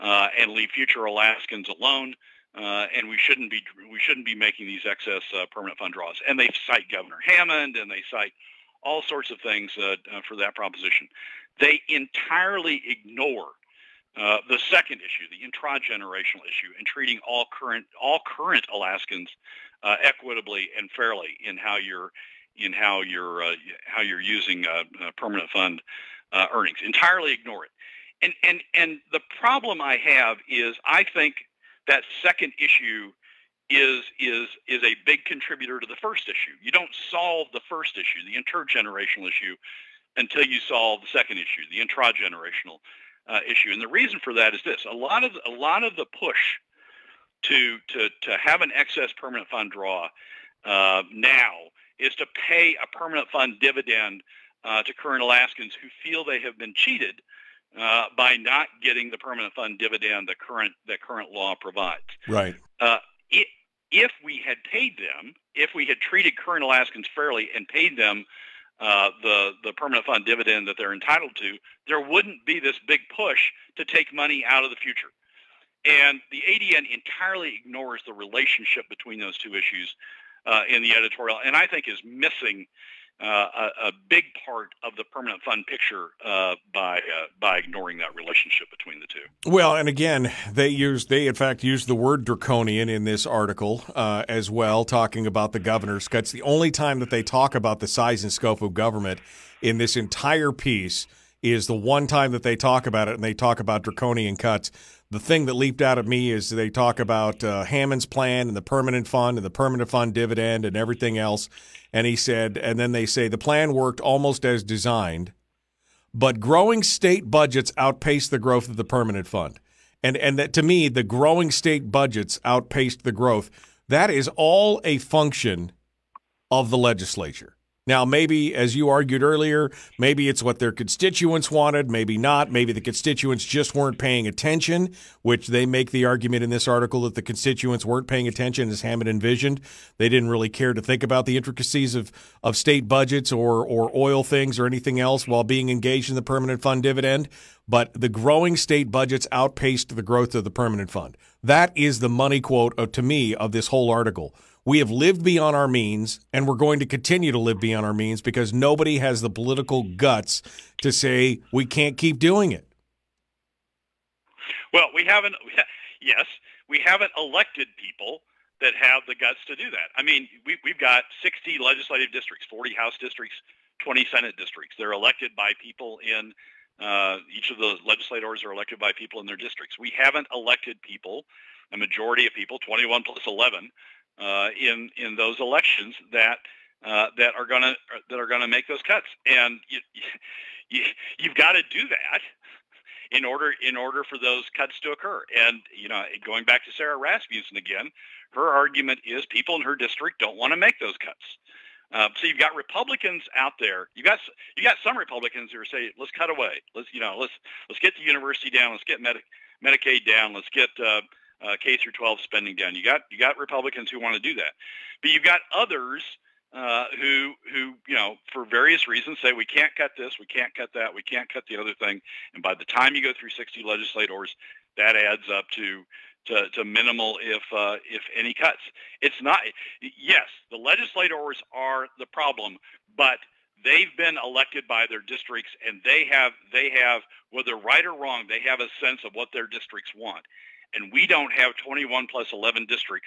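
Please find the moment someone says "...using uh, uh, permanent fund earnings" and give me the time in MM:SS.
00:24.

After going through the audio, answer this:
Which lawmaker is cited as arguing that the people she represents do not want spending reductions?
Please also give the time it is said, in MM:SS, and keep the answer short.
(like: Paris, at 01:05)
Sara Rasmussen, at 03:16.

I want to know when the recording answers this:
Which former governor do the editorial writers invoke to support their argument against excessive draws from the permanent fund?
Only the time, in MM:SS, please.
00:06.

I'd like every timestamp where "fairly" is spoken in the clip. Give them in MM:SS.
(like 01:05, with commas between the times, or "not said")
00:20, 01:07.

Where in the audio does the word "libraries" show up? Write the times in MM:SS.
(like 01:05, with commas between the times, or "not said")
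not said.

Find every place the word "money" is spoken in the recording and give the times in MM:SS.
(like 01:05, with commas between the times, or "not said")
01:14, 02:32.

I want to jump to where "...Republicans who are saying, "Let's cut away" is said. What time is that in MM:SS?
03:24.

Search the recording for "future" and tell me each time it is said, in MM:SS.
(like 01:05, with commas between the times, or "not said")
00:00, 01:14.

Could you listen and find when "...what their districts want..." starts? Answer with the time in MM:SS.
03:59.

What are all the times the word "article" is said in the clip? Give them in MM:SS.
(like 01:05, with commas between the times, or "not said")
01:33, 02:16, 02:33.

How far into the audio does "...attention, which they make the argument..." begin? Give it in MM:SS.
02:14.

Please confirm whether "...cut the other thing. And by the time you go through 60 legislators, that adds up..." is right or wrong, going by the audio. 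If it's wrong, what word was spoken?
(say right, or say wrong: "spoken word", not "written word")
right.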